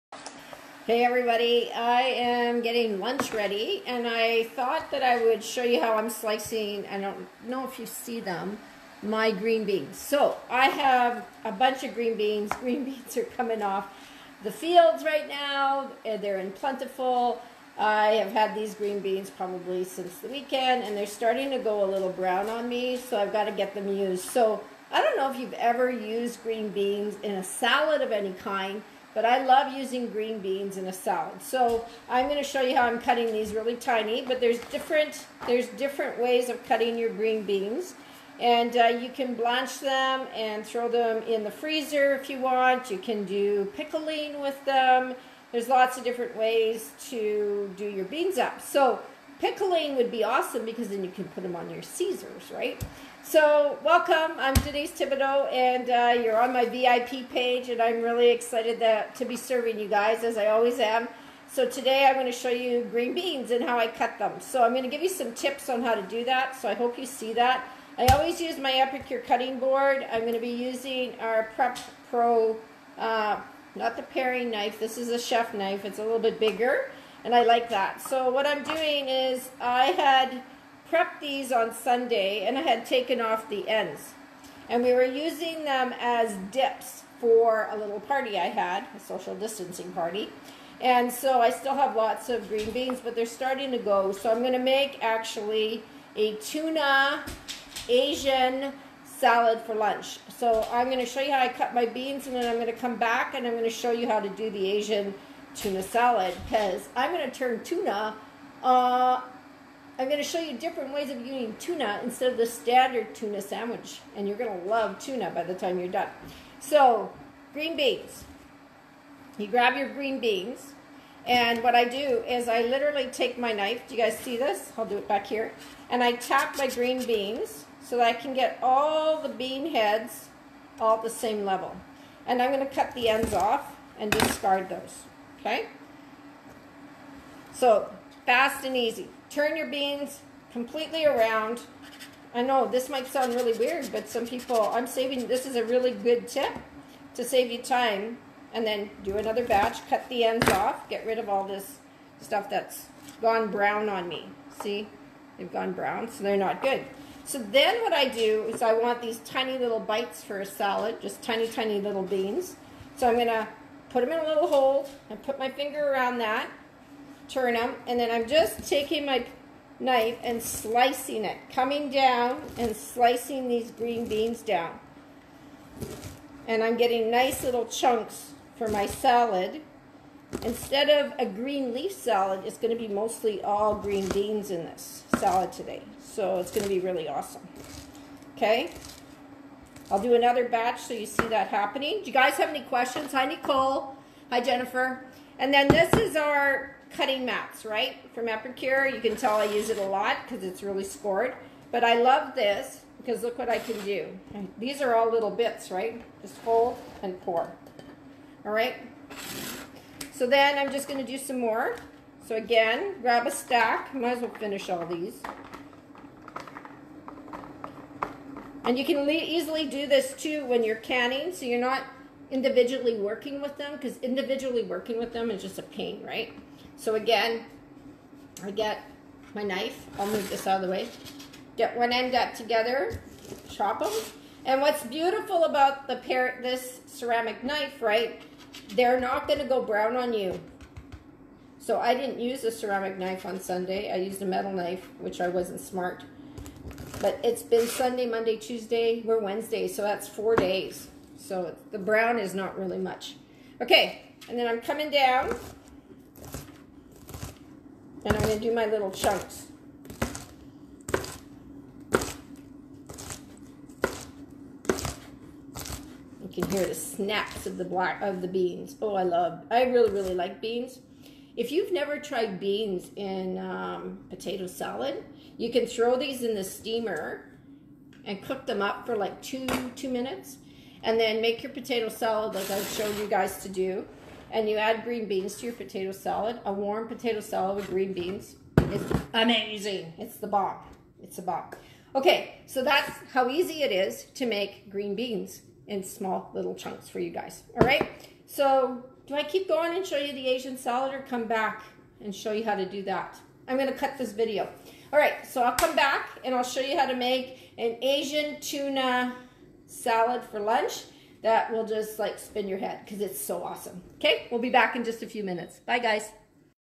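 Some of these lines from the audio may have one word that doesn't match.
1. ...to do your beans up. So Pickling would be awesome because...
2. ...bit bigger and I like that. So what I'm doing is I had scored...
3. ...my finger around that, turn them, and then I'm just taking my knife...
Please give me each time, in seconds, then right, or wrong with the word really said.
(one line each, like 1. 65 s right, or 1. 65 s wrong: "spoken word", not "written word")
1. 47 s right
2. 76 s wrong: "prepped", not "scored"
3. 165 s right.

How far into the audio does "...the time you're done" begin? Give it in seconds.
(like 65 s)
115 s.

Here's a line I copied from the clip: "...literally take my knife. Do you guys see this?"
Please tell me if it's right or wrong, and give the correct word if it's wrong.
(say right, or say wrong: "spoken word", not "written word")
right.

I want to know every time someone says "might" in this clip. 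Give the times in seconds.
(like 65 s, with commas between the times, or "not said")
142 s, 213 s.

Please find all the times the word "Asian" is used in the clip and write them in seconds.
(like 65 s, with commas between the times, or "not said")
97 s, 104 s, 300 s, 307 s.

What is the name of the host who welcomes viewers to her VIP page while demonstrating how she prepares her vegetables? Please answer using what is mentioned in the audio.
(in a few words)
Denise Thibodeau.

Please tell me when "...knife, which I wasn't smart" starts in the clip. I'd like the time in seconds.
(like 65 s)
244 s.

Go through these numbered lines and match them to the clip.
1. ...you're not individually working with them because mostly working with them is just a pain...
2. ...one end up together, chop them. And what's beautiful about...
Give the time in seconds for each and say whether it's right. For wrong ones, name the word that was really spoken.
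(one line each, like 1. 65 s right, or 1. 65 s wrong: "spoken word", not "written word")
1. 221 s wrong: "individually", not "mostly"
2. 231 s right.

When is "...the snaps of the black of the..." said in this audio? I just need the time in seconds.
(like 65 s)
266 s.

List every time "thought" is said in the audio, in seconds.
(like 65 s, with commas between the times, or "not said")
4 s.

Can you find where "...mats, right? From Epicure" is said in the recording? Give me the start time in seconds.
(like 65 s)
197 s.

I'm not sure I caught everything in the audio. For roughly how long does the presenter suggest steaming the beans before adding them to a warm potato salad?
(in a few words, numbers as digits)
2 minutes.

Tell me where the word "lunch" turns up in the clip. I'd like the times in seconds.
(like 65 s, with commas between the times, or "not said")
2 s, 99 s, 310 s.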